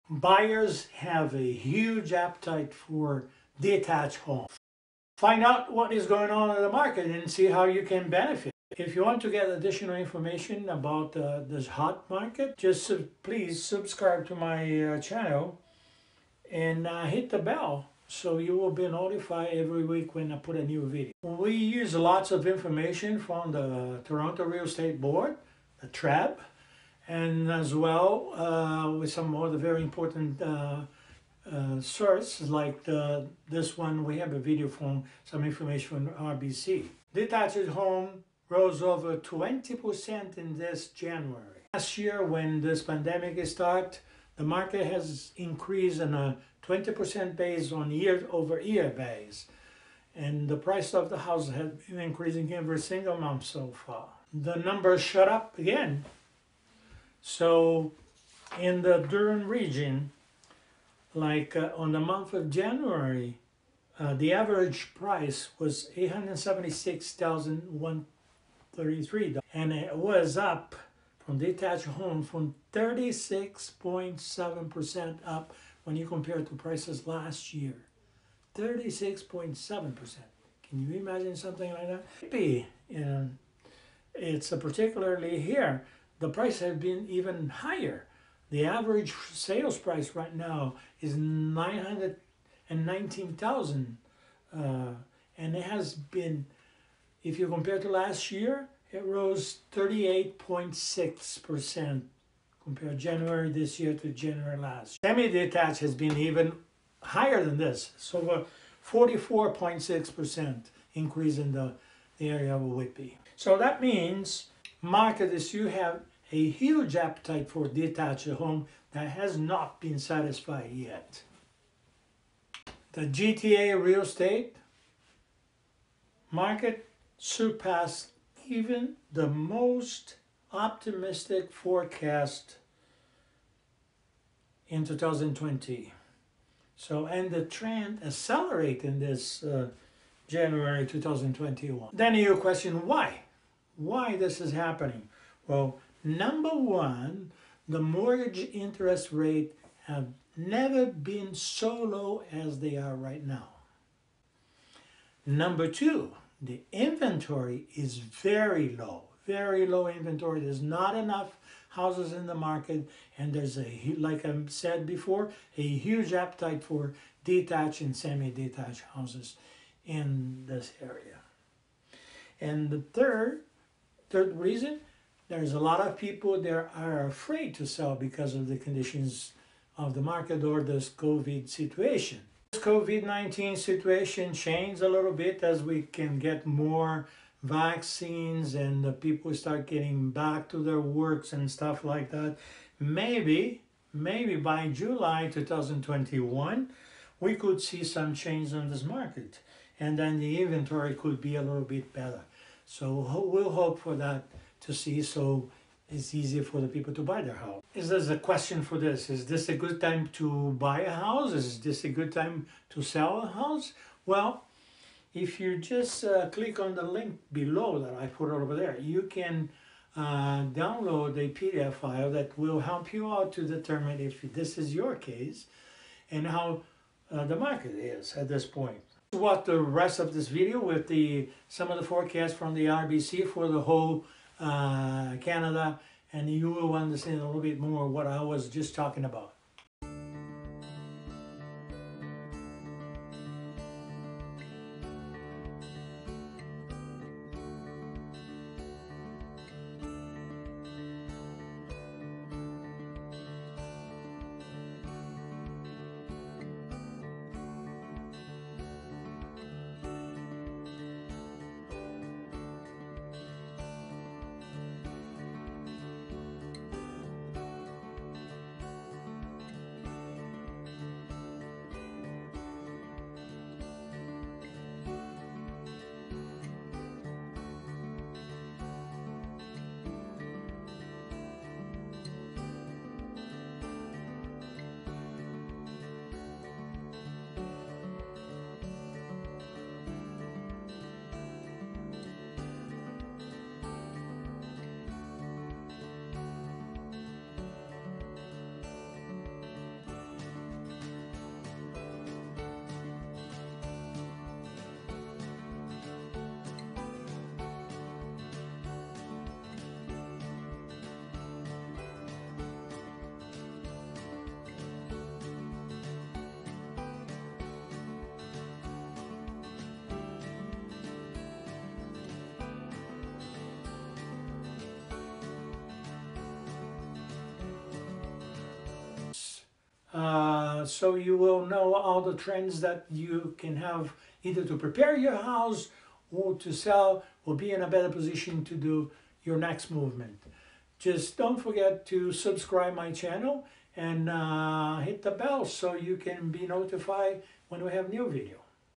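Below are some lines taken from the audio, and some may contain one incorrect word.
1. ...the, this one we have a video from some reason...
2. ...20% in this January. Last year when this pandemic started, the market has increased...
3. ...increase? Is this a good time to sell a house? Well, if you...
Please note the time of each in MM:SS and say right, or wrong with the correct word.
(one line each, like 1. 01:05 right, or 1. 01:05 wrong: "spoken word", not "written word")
1. 00:32 wrong: "information", not "reason"
2. 00:39 right
3. 03:30 wrong: "house", not "increase".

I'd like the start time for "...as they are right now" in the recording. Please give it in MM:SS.
02:32.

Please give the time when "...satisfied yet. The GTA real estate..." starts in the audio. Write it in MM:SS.
01:59.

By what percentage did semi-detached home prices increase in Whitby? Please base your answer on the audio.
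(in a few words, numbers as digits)
44.6%.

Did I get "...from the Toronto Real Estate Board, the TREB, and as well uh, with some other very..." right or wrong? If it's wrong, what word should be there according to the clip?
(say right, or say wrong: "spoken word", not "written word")
right.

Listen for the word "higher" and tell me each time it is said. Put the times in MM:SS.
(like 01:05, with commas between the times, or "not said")
01:27, 01:47.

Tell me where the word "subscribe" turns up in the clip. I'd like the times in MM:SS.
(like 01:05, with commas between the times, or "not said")
00:13, 05:42.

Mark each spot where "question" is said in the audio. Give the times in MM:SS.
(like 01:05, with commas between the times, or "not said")
02:22, 03:28.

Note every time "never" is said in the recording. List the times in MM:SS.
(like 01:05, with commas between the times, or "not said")
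02:30.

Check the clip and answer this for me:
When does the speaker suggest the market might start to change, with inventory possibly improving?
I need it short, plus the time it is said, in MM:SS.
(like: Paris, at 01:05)
July 2021, at 03:14.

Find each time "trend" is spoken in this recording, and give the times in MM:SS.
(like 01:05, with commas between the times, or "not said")
02:17, 05:32.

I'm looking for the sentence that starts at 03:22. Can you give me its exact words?
So we'll hope for that to see so it's easier for the people to buy their house.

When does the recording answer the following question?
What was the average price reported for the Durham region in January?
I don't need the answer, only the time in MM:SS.
01:05.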